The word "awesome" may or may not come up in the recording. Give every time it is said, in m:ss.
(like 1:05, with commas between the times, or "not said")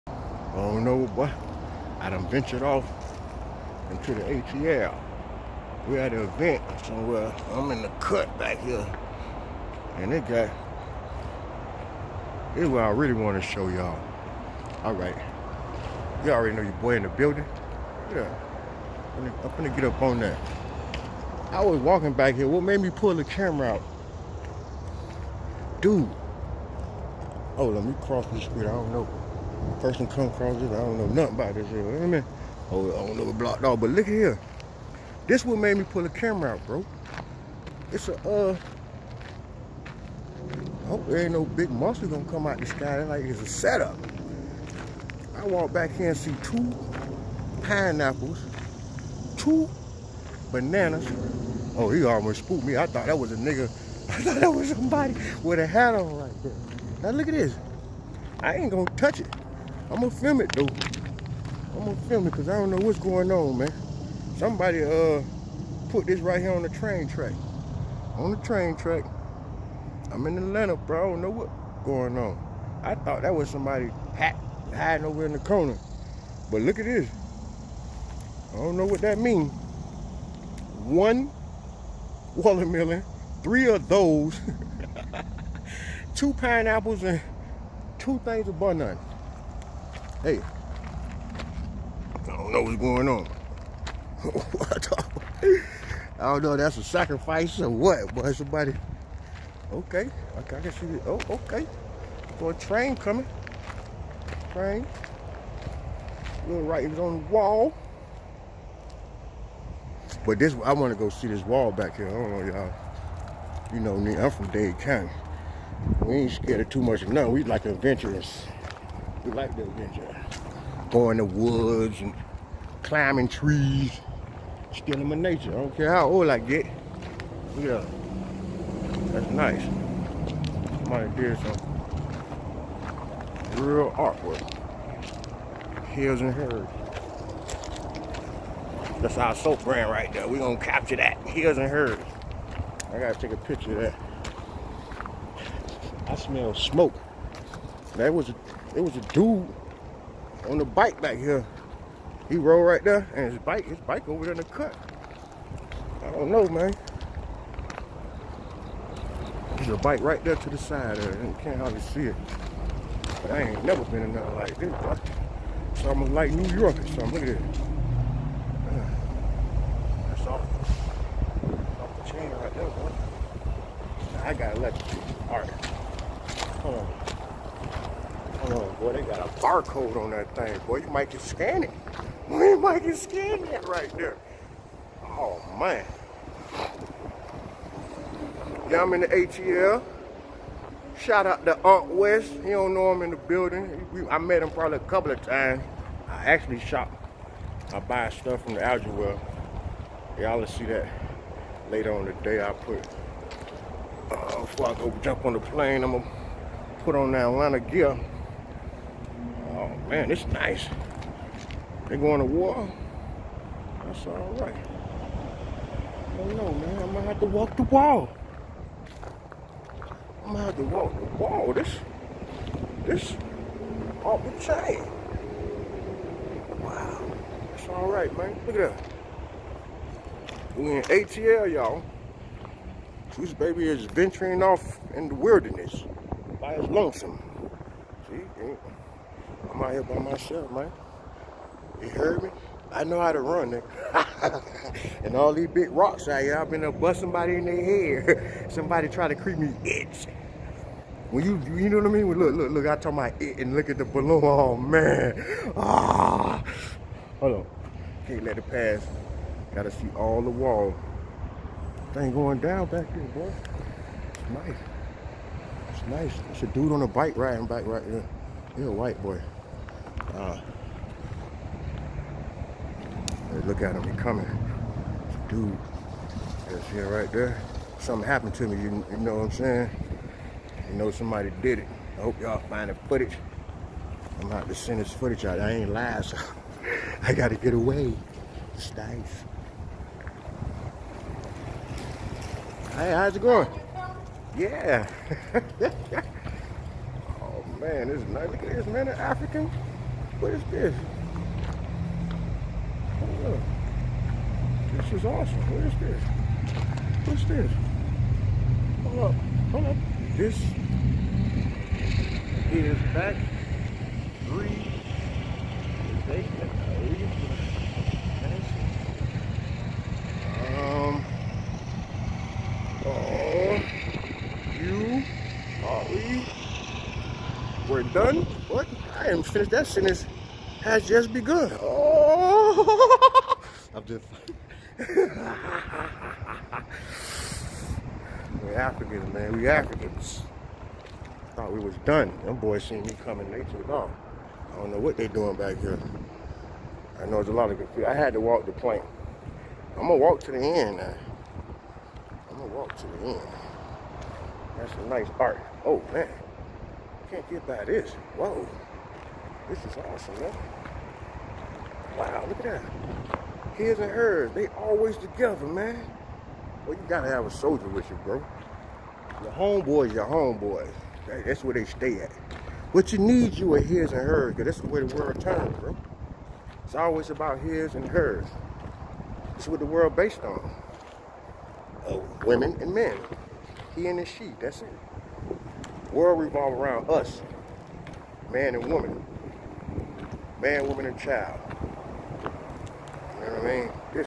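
5:05, 5:59.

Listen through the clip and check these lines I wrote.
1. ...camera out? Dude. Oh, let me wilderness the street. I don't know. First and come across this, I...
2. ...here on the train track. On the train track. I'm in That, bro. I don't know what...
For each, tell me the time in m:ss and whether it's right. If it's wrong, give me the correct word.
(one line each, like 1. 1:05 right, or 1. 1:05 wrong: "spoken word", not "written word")
1. 0:23 wrong: "cross", not "wilderness"
2. 1:06 wrong: "Atlanta", not "That".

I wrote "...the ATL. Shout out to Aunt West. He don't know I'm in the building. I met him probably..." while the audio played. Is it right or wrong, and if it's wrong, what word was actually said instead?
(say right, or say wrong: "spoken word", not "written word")
right.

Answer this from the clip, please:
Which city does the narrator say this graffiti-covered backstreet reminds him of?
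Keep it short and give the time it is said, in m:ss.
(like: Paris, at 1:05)
New York, at 2:46.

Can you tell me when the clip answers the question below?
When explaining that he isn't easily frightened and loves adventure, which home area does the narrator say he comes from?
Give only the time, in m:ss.
1:54.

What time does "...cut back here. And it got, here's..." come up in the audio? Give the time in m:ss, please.
0:08.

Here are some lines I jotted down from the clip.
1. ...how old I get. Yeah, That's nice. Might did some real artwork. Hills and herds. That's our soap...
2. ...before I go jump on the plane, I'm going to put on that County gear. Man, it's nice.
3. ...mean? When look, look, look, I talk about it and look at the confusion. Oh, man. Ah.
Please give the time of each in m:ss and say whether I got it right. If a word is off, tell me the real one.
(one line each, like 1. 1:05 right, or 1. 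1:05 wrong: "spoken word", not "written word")
1. 2:05 right
2. 3:24 wrong: "Atlanta", not "County"
3. 4:11 wrong: "balloon", not "confusion".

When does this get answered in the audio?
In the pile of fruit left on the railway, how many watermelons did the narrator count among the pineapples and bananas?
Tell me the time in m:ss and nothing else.
1:20.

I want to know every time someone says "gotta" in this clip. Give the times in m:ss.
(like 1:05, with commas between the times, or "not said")
2:22, 2:54, 4:19, 4:47, 6:06.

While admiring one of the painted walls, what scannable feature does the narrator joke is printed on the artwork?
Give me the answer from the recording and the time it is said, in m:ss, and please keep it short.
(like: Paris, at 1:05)
A barcode, at 2:59.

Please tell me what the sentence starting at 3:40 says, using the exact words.
I gonna have to walk the wall.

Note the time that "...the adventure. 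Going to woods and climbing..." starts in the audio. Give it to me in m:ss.
1:59.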